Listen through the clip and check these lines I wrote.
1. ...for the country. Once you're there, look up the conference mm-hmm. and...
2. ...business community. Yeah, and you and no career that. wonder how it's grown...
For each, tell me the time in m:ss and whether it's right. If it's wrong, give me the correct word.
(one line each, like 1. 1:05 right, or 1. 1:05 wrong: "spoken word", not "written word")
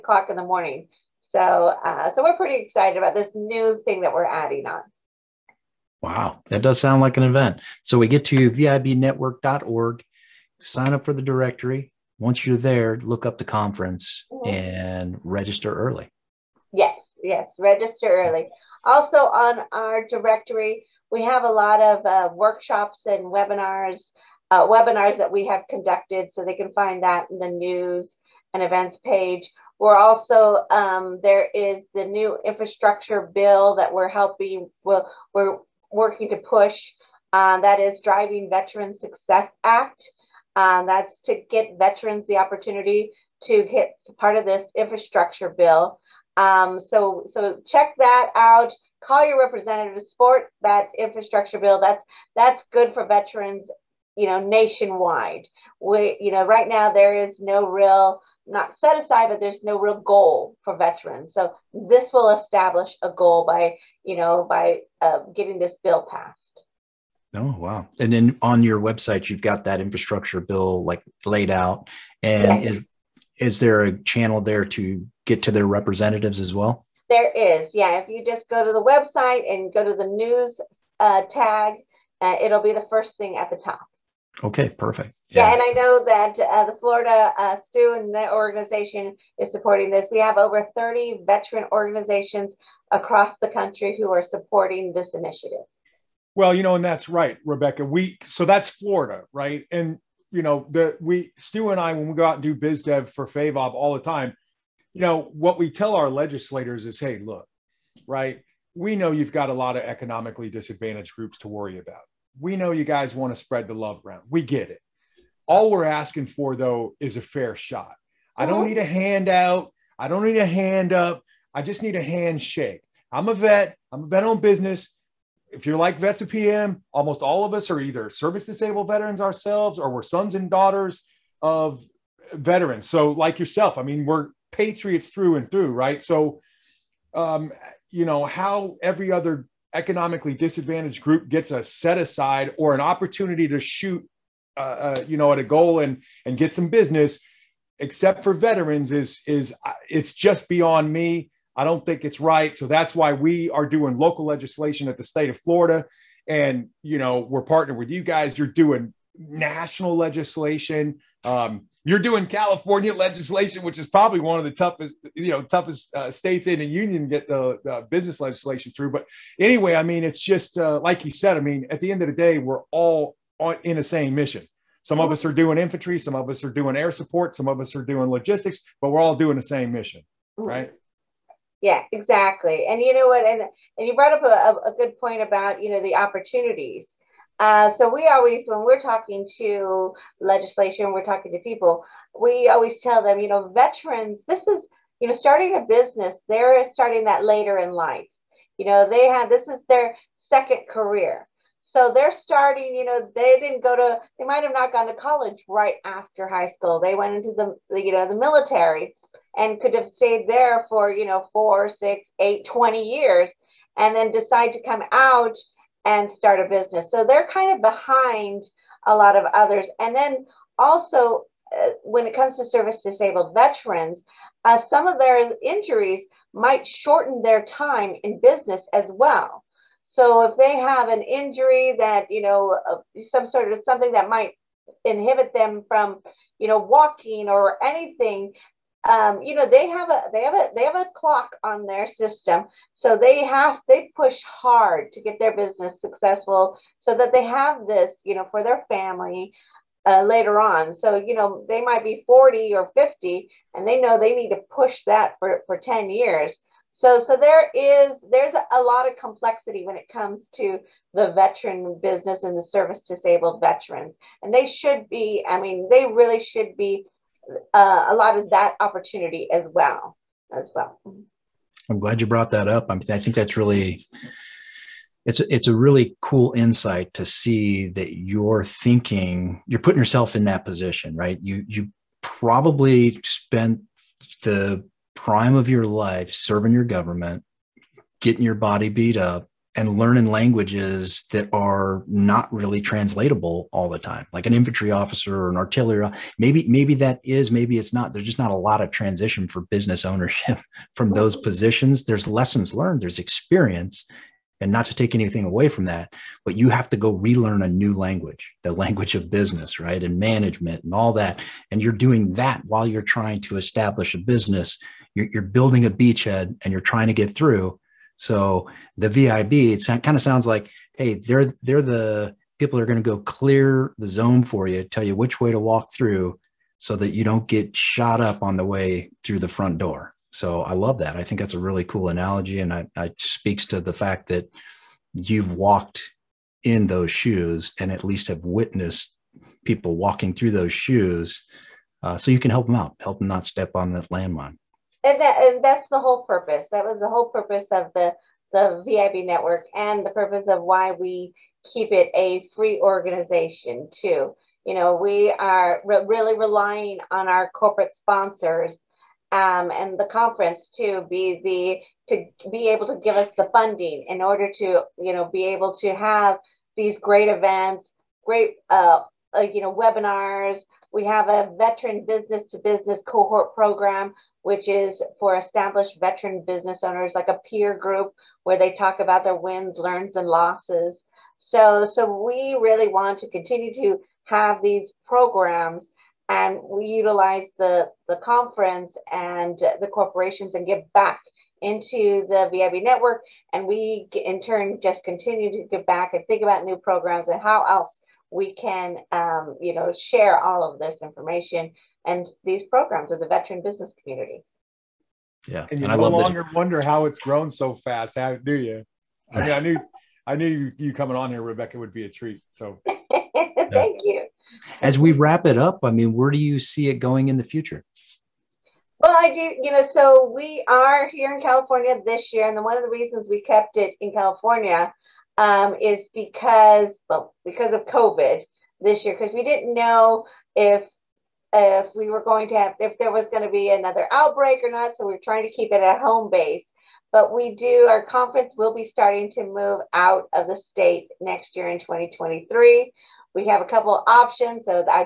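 1. 0:11 wrong: "directory", not "country"
2. 6:43 wrong: "longer", not "career".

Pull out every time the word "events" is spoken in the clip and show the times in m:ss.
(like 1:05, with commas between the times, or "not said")
0:07, 0:28, 6:07.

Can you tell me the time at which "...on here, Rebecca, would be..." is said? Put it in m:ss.
6:50.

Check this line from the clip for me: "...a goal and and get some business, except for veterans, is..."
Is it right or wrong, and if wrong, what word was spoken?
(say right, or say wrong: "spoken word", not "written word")
right.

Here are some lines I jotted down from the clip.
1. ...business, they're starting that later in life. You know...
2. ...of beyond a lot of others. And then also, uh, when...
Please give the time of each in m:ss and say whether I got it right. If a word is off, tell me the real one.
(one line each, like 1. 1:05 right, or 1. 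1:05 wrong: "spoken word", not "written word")
1. 3:15 right
2. 3:37 wrong: "behind", not "beyond".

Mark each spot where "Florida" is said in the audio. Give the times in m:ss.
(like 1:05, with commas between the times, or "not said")
1:26, 1:38, 2:35.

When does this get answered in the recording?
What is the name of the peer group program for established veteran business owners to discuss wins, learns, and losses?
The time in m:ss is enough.
6:11.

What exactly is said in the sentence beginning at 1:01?
So this will establish a goal by you know by uh, getting this bill passed.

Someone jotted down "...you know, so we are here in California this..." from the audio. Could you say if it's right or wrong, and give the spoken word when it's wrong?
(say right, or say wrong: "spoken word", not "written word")
right.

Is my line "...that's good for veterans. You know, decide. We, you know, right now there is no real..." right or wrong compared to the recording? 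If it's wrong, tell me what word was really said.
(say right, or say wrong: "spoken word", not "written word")
wrong: "nationwide", not "decide".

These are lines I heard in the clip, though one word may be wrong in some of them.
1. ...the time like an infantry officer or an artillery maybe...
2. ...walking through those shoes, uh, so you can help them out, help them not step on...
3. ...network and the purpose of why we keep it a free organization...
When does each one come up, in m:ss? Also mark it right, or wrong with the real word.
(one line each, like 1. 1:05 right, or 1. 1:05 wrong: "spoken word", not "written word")
1. 4:53 right
2. 5:39 right
3. 5:49 right.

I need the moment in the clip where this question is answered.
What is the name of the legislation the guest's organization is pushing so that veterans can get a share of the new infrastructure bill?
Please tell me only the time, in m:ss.
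0:38.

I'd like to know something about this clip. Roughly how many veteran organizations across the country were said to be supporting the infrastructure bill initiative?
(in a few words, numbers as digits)
over 30.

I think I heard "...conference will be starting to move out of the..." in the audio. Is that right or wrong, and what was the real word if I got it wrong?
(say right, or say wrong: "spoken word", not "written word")
right.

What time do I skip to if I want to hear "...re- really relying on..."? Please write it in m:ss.
5:55.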